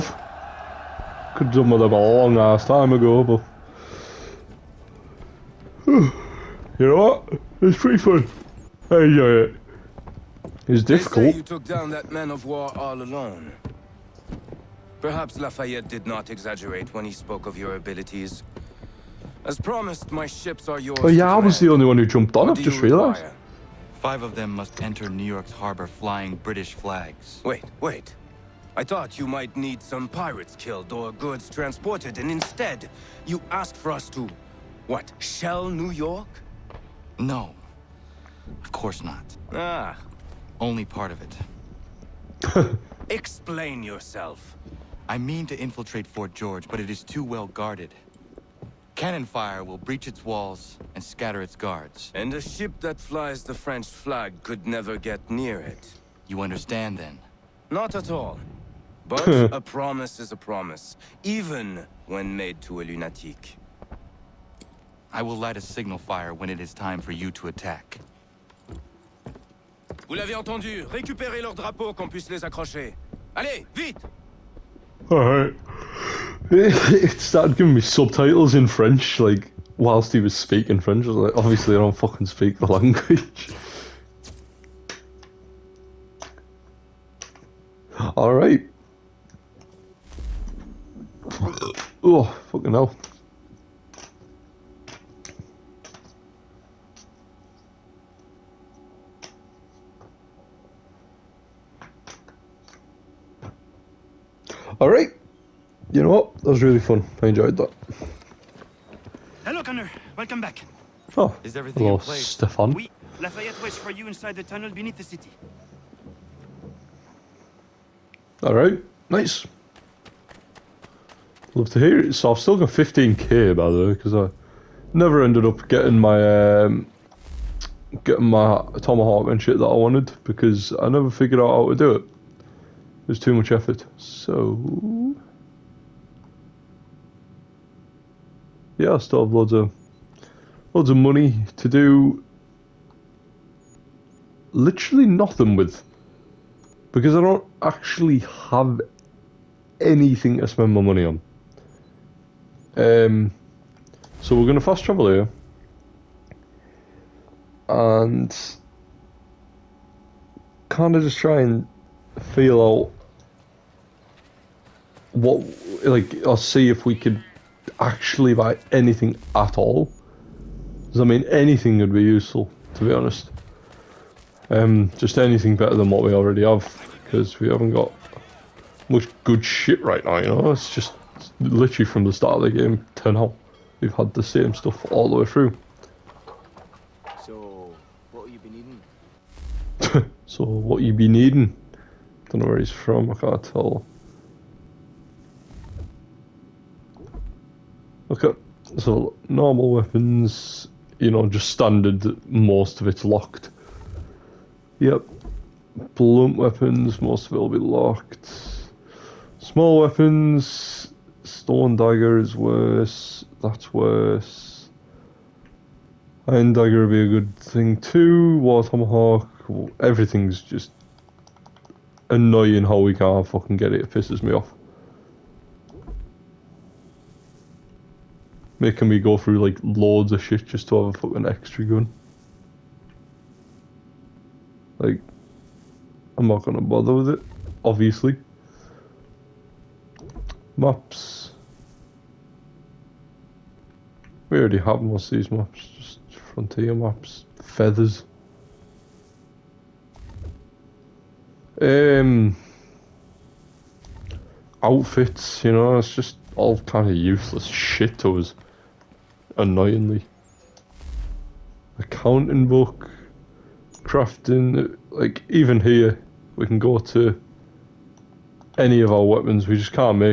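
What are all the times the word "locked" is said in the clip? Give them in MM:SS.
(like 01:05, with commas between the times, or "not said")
03:23, 03:27.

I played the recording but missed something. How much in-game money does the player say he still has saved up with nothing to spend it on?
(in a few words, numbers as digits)
15k.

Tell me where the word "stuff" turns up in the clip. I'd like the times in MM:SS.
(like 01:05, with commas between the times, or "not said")
03:04.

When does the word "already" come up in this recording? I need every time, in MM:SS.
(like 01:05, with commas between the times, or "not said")
02:56, 04:04.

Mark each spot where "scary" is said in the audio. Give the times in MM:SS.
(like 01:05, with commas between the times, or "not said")
not said.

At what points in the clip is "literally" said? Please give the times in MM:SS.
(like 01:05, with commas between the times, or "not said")
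02:24, 03:01.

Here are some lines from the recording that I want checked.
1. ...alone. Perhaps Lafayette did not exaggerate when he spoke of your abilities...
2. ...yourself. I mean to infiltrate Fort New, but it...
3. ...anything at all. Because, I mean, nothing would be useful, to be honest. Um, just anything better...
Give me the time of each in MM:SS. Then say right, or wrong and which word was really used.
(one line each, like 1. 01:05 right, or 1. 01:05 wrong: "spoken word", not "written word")
1. 00:12 right
2. 00:43 wrong: "George", not "New"
3. 02:48 wrong: "anything", not "nothing".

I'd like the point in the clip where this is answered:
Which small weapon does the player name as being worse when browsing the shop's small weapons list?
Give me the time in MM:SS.
03:31.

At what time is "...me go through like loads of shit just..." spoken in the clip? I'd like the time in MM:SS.
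03:48.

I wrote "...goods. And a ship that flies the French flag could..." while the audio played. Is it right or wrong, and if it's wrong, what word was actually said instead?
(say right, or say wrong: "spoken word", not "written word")
wrong: "guards", not "goods".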